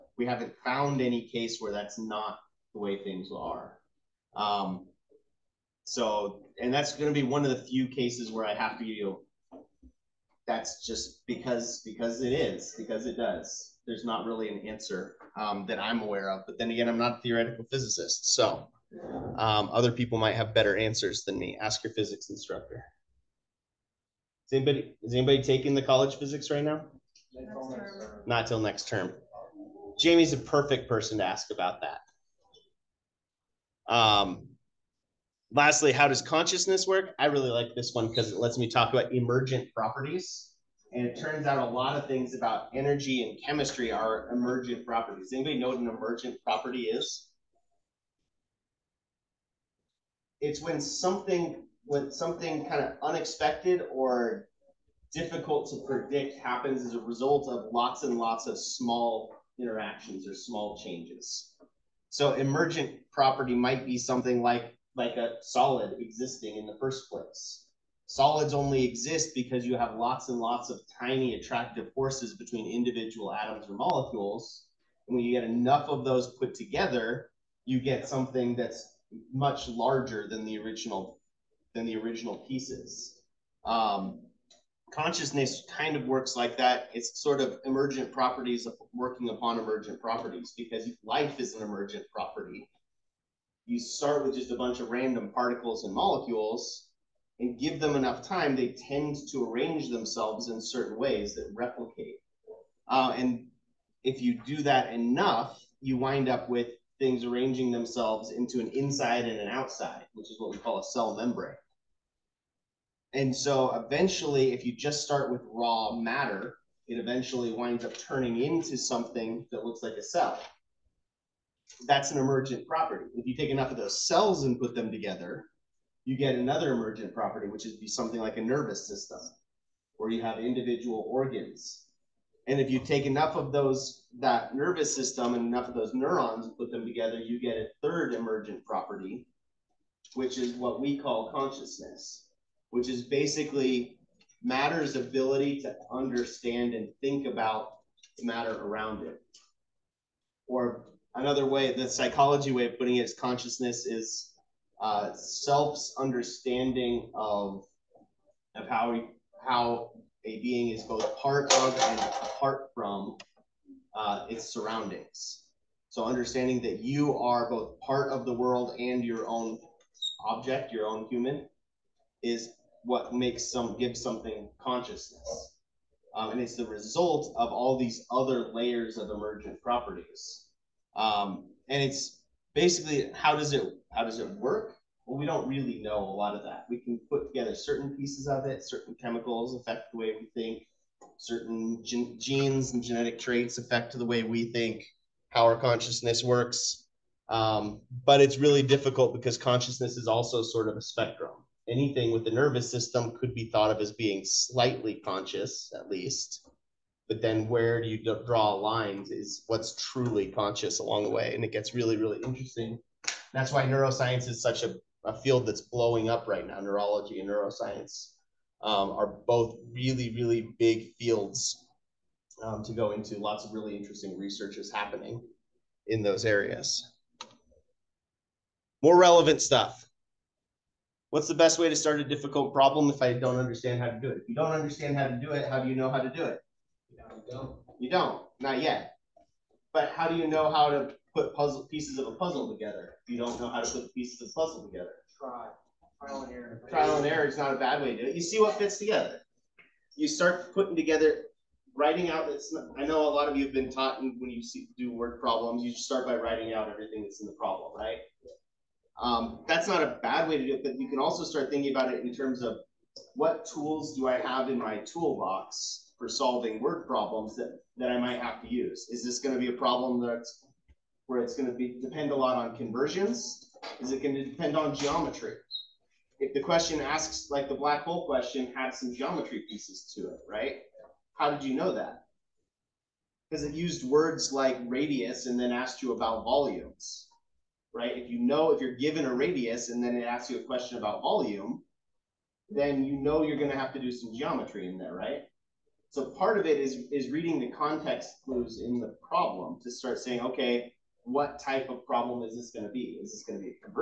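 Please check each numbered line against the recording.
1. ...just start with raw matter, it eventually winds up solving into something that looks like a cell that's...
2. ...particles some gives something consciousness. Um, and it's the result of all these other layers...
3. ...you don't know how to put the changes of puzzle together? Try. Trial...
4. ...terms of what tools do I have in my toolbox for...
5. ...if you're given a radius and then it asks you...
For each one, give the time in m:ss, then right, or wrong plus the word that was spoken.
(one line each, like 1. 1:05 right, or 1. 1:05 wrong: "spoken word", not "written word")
1. 1:54 wrong: "turning", not "solving"
2. 2:53 wrong: "makes", not "particles"
3. 4:03 wrong: "pieces", not "changes"
4. 4:22 right
5. 4:48 right.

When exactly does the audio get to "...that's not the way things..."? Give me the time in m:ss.
0:01.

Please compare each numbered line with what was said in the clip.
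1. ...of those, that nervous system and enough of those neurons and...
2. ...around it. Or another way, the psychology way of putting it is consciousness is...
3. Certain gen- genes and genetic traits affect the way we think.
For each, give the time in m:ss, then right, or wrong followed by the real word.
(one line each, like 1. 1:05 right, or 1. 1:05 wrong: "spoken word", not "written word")
1. 2:13 right
2. 2:28 right
3. 3:11 right.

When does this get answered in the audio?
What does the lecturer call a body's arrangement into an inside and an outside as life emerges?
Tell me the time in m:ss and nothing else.
1:50.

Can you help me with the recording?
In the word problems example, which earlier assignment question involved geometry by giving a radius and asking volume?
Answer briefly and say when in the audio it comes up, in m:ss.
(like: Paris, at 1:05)
the black hole question, at 4:37.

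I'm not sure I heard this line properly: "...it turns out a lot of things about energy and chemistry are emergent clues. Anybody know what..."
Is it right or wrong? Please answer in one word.
wrong.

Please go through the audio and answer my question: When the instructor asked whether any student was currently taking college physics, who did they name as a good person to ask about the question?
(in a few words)
Jamie.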